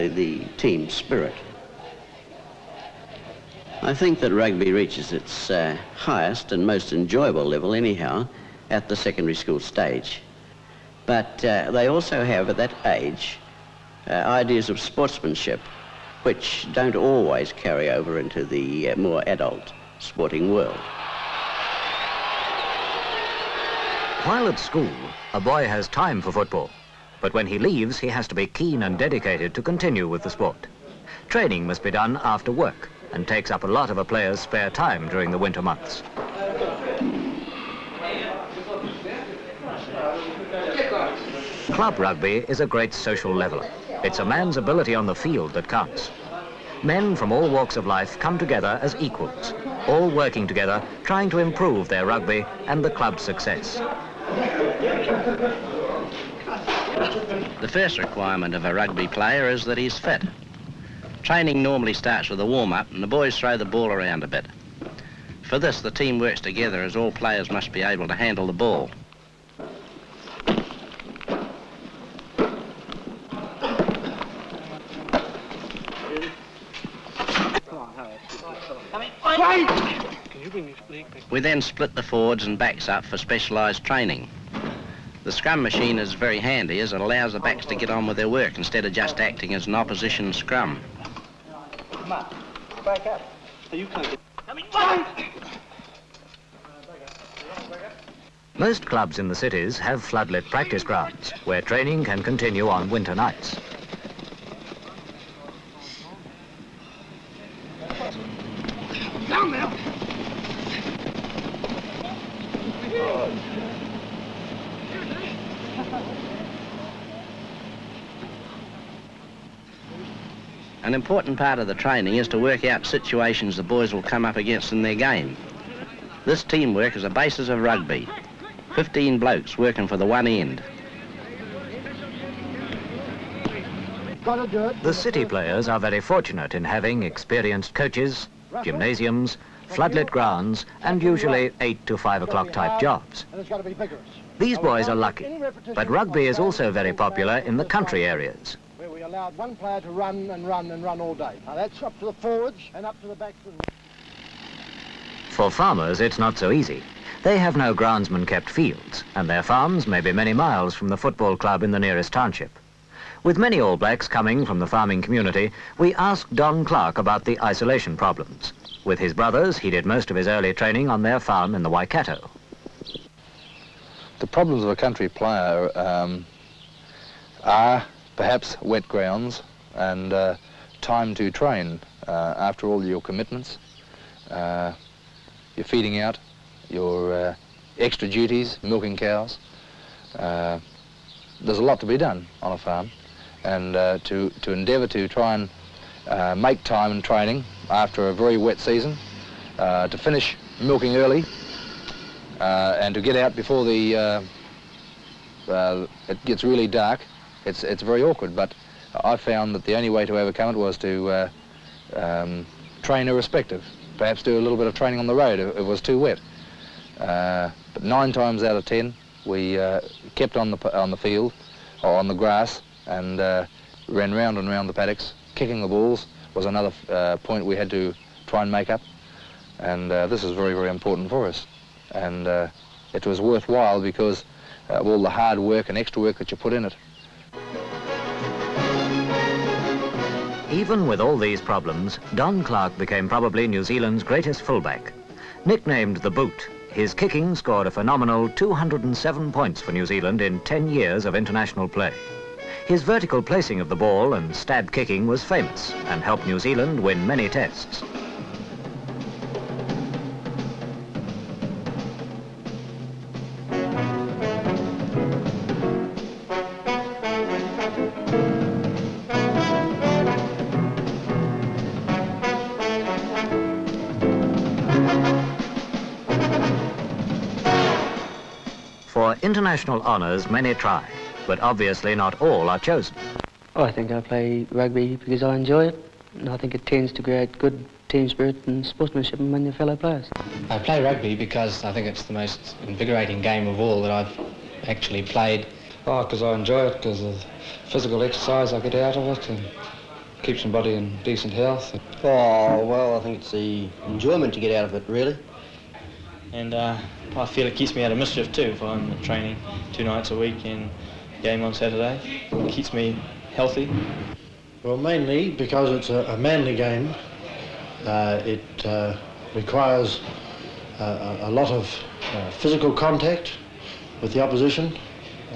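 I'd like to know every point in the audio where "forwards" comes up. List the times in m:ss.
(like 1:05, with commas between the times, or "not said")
1:22, 2:32.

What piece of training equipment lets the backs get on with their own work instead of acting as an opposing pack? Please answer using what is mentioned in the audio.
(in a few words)
Scrum machine.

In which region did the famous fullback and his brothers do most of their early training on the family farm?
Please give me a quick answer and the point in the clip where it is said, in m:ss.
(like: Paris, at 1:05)
Waikato, at 2:51.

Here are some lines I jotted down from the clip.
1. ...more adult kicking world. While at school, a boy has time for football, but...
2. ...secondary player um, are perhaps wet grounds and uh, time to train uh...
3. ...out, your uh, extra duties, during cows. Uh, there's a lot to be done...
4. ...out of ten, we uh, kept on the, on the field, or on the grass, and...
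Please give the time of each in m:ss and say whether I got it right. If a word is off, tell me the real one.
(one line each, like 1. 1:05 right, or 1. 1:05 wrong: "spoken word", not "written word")
1. 0:18 wrong: "sporting", not "kicking"
2. 2:54 wrong: "country", not "secondary"
3. 3:05 wrong: "milking", not "during"
4. 3:38 right.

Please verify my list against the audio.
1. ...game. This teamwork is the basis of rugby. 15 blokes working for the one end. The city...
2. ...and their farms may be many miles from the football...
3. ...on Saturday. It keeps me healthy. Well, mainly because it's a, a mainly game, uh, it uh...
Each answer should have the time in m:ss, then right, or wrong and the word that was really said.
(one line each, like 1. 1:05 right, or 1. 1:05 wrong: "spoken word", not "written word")
1. 2:04 right
2. 2:39 right
3. 5:11 wrong: "manly", not "mainly".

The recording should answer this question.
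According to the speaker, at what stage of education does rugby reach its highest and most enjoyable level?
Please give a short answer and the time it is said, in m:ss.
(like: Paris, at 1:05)
Secondary school, at 0:08.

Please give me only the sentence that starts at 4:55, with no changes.
Oh, because I enjoy it, because of physical exercise I get out of it, and keeps my body in decent health.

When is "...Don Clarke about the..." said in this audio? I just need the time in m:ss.
2:46.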